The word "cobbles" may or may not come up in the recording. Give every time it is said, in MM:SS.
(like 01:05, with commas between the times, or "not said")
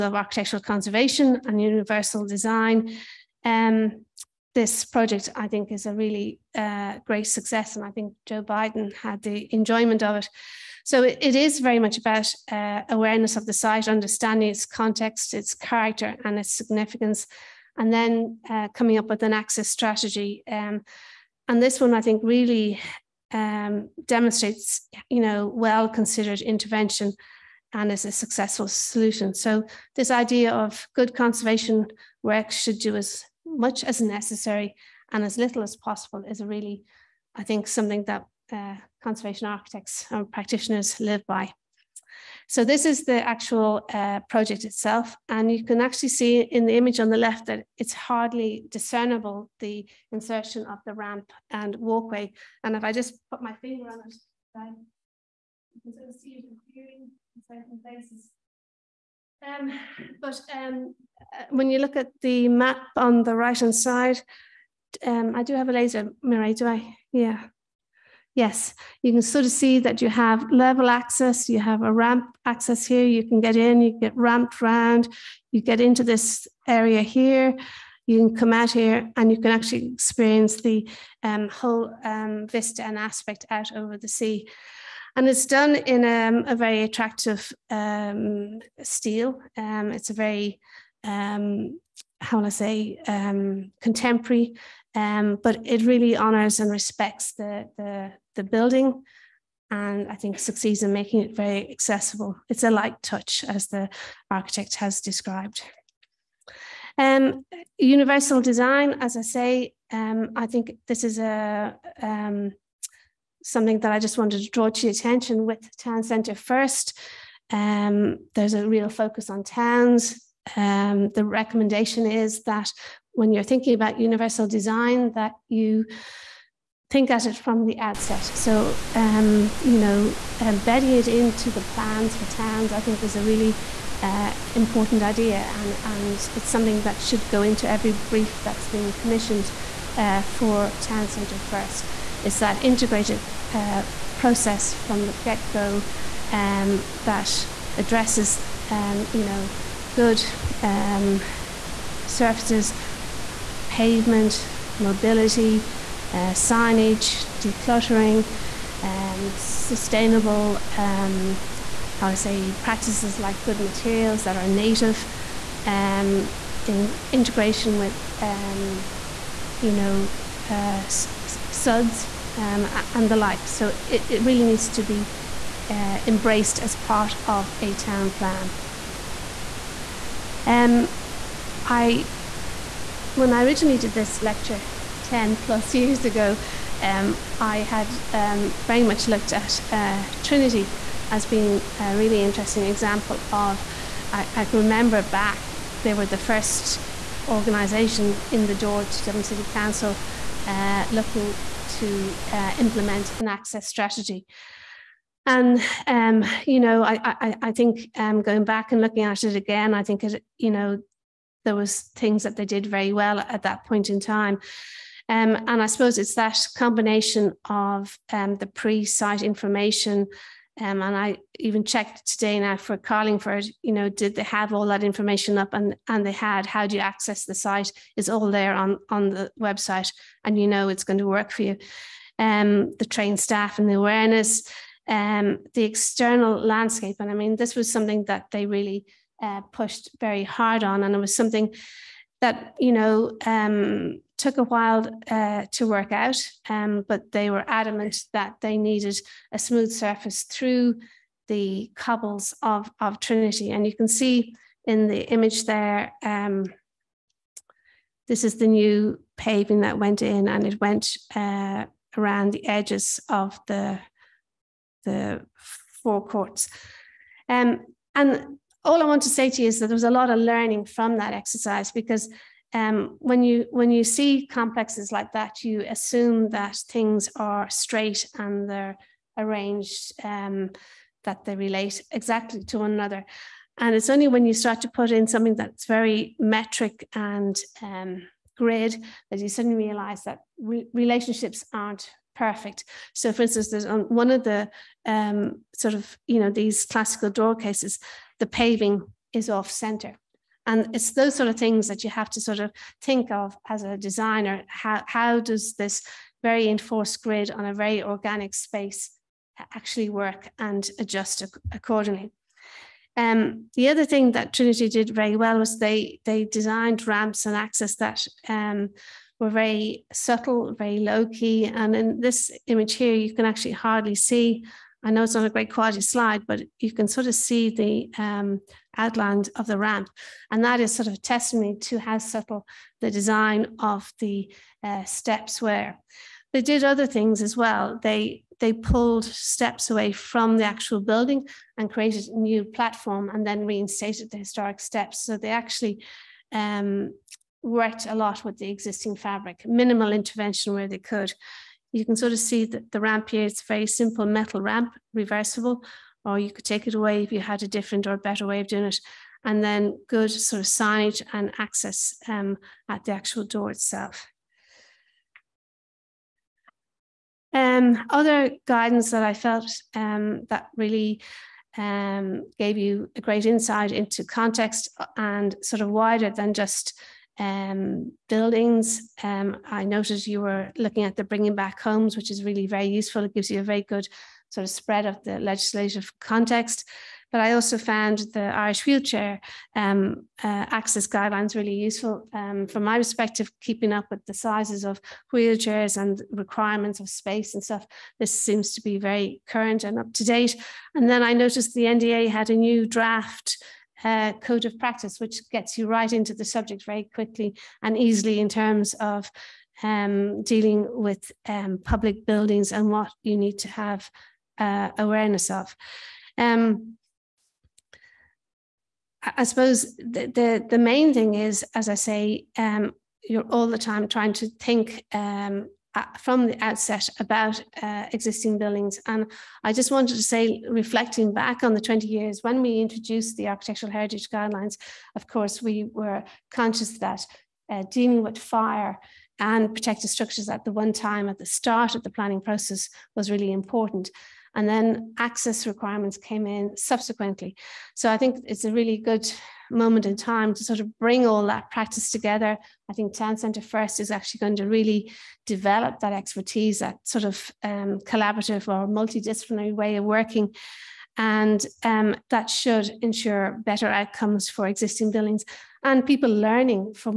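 04:11.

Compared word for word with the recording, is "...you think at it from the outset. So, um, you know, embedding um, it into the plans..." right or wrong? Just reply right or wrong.
right.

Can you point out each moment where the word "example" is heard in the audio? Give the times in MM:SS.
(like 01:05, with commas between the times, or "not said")
03:12.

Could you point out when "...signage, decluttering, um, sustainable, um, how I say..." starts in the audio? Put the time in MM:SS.
02:36.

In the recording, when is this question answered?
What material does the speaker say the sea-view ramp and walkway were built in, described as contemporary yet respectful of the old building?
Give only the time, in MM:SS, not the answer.
01:28.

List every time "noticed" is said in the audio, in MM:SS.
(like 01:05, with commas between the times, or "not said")
06:19, 06:41.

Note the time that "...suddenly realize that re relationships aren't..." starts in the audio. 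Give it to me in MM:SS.
04:49.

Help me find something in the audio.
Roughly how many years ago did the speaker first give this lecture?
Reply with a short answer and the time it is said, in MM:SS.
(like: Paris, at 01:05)
10, at 03:05.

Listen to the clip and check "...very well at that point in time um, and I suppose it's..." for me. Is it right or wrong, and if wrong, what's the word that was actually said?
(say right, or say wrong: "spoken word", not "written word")
right.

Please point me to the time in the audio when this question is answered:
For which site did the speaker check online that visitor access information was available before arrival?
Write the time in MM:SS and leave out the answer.
03:42.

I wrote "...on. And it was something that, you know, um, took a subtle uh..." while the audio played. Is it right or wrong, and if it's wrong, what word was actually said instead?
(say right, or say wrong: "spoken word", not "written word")
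wrong: "while", not "subtle".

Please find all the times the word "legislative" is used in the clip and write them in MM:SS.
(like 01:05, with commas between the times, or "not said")
06:25.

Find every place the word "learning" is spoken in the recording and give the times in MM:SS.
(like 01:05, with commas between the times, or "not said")
04:30, 07:46.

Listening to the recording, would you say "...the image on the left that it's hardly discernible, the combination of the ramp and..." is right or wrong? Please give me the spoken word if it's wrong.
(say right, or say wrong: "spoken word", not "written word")
wrong: "insertion", not "combination".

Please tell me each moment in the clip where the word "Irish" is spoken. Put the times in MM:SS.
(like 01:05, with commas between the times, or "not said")
06:28.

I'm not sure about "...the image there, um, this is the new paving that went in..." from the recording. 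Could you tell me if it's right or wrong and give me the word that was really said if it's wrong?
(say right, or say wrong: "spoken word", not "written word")
right.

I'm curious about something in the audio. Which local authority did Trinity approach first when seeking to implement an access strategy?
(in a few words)
Dublin City Council.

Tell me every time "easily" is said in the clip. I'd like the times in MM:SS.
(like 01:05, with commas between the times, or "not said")
06:47.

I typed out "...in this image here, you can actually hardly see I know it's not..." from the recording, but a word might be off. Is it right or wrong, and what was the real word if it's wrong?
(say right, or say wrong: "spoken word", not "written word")
right.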